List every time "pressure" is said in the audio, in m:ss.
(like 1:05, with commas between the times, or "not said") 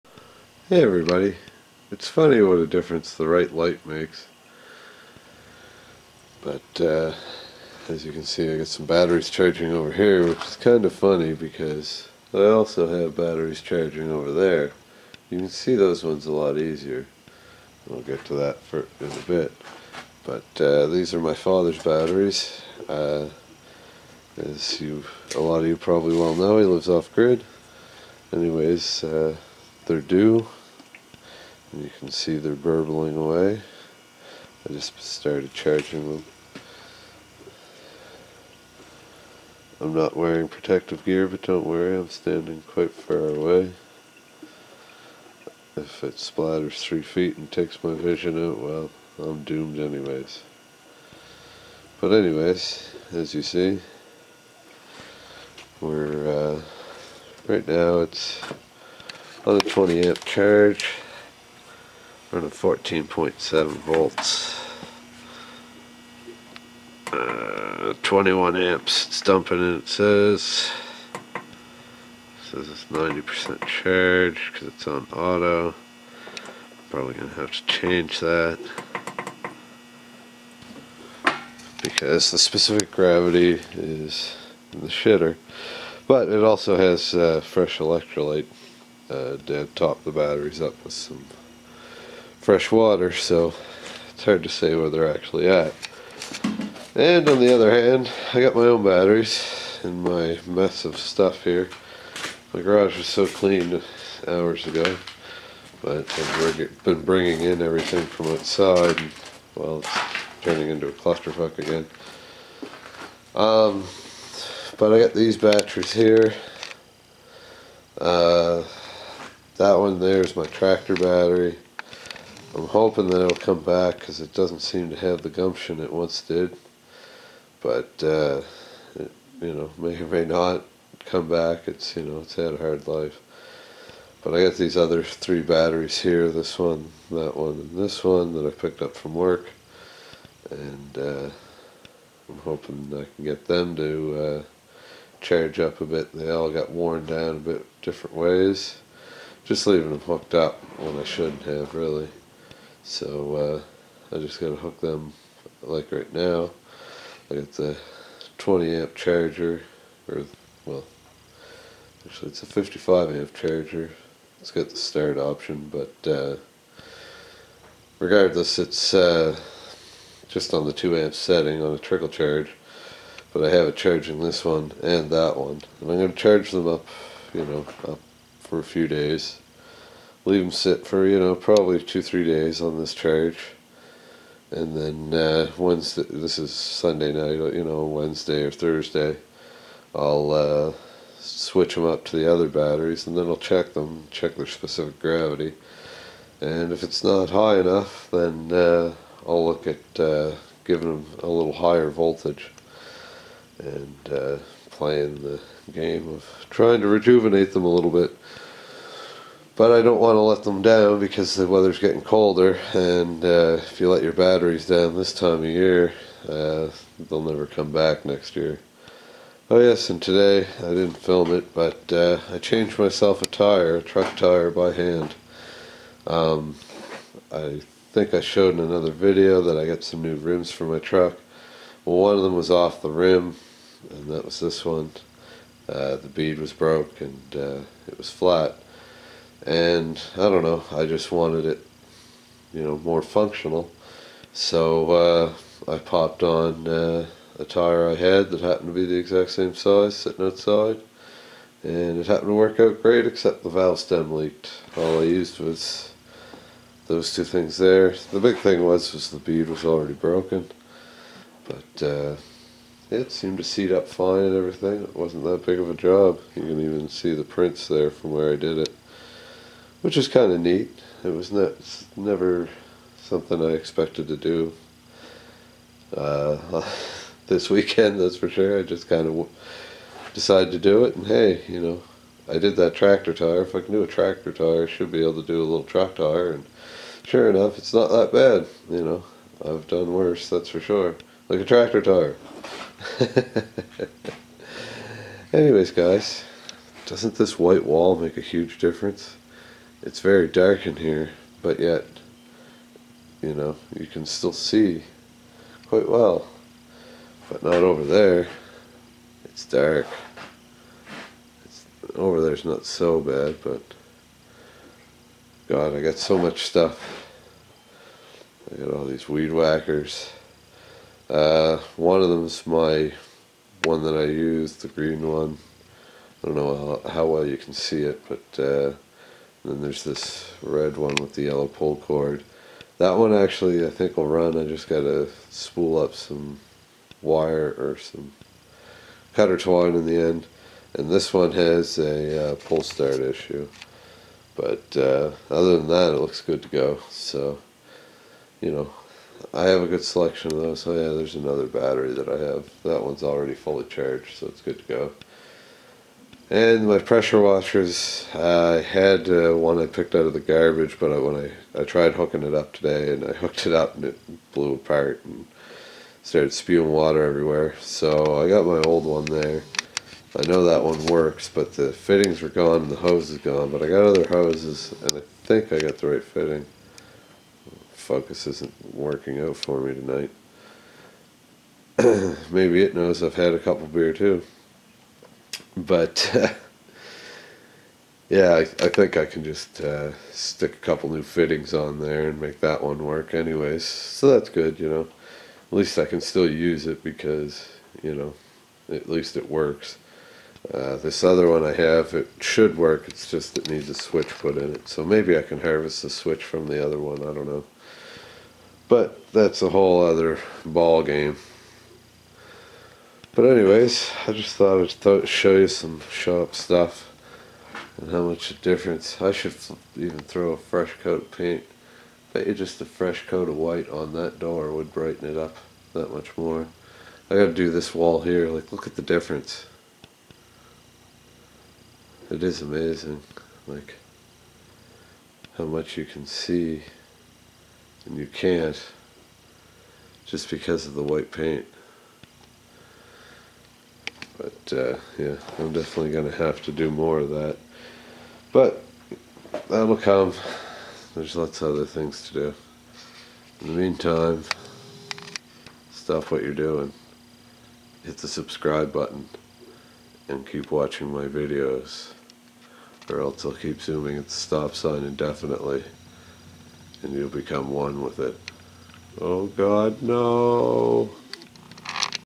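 5:56.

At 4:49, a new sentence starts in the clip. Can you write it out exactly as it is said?
I've done worse, that's for sure.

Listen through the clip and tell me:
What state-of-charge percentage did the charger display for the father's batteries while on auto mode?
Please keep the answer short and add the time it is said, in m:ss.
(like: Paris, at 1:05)
90%, at 1:12.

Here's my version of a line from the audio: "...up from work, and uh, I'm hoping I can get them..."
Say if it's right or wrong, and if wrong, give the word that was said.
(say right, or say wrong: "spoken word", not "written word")
right.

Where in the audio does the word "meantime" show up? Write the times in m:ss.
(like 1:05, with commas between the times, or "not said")
7:33.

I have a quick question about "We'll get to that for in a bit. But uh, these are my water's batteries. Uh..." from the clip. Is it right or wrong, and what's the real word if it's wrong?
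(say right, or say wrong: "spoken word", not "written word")
wrong: "father", not "water".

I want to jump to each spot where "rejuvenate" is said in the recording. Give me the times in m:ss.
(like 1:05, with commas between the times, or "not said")
3:26.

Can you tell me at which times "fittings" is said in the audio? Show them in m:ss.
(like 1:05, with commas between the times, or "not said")
6:11, 6:16, 6:31.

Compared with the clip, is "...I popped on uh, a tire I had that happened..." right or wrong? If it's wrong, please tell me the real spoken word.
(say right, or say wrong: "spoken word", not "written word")
right.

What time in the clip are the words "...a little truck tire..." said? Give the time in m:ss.
4:45.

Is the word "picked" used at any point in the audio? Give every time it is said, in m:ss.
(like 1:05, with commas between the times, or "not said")
2:18, 5:59.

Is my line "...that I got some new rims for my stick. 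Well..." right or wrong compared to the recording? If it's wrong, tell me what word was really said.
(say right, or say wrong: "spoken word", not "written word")
wrong: "truck", not "stick".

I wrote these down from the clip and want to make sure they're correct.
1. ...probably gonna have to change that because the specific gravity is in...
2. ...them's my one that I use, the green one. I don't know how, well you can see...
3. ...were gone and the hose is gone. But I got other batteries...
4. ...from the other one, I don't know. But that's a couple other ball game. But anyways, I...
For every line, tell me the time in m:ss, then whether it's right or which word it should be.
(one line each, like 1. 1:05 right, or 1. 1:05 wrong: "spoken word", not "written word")
1. 1:16 right
2. 5:22 right
3. 6:12 wrong: "hoses", not "batteries"
4. 6:46 wrong: "whole", not "couple".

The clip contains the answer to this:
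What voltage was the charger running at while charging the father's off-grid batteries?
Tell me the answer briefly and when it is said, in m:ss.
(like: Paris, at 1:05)
14.7 volts, at 1:02.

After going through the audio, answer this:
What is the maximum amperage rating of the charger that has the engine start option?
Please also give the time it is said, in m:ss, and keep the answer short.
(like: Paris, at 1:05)
55 amp, at 2:42.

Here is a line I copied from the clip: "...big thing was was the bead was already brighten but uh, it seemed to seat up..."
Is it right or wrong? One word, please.
wrong.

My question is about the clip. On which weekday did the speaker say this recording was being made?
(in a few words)
Sunday.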